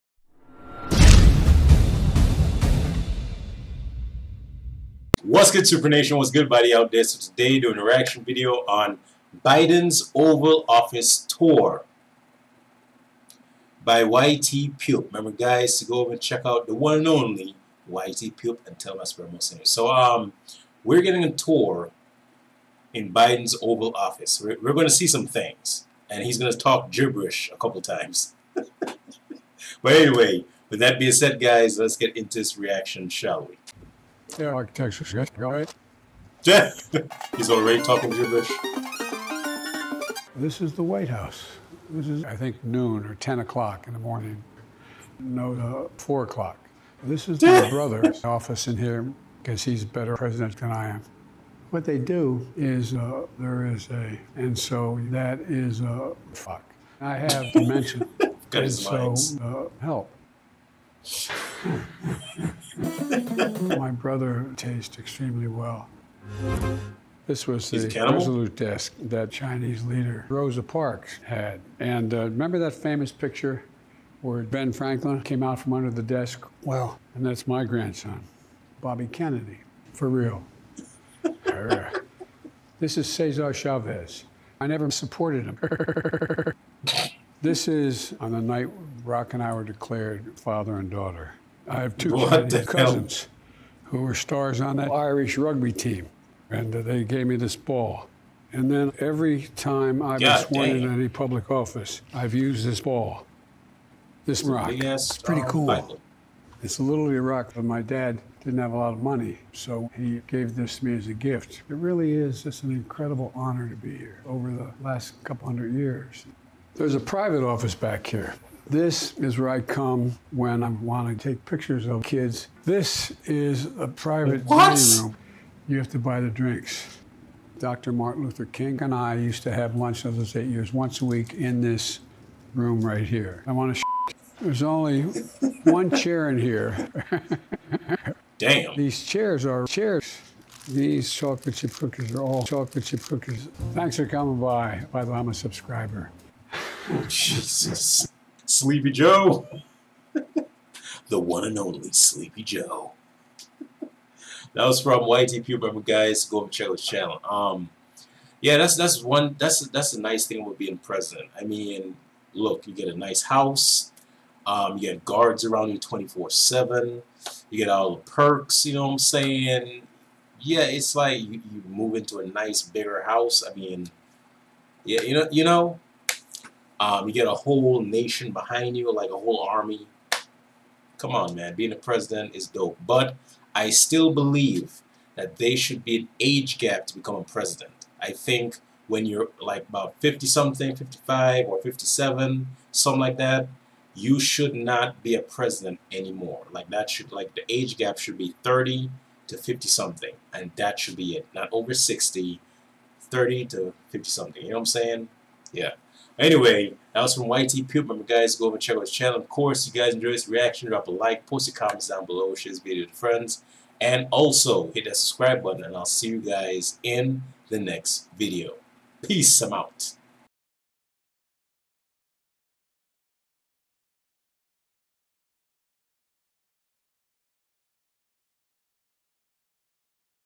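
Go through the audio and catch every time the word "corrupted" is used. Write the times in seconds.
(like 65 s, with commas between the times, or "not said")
not said.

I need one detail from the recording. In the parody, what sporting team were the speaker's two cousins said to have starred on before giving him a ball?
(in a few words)
Irish rugby team.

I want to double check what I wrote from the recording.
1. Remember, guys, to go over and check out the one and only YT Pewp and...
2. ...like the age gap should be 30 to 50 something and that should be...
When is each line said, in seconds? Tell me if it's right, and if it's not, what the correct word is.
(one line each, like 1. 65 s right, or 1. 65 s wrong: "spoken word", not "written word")
1. 15 s right
2. 197 s right.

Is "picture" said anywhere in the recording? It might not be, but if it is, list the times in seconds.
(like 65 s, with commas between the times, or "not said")
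73 s, 121 s.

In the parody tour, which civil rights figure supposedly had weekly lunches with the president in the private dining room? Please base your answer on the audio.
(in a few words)
Martin Luther King.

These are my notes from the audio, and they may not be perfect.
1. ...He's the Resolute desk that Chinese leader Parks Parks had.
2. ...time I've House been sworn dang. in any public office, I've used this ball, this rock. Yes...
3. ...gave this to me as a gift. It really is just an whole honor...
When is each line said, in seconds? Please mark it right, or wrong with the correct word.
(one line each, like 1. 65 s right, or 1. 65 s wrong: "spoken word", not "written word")
1. 67 s wrong: "Rosa", not "Parks"
2. 99 s wrong: "God", not "House"
3. 110 s wrong: "incredible", not "whole".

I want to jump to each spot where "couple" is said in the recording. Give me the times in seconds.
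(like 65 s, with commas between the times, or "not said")
27 s, 115 s.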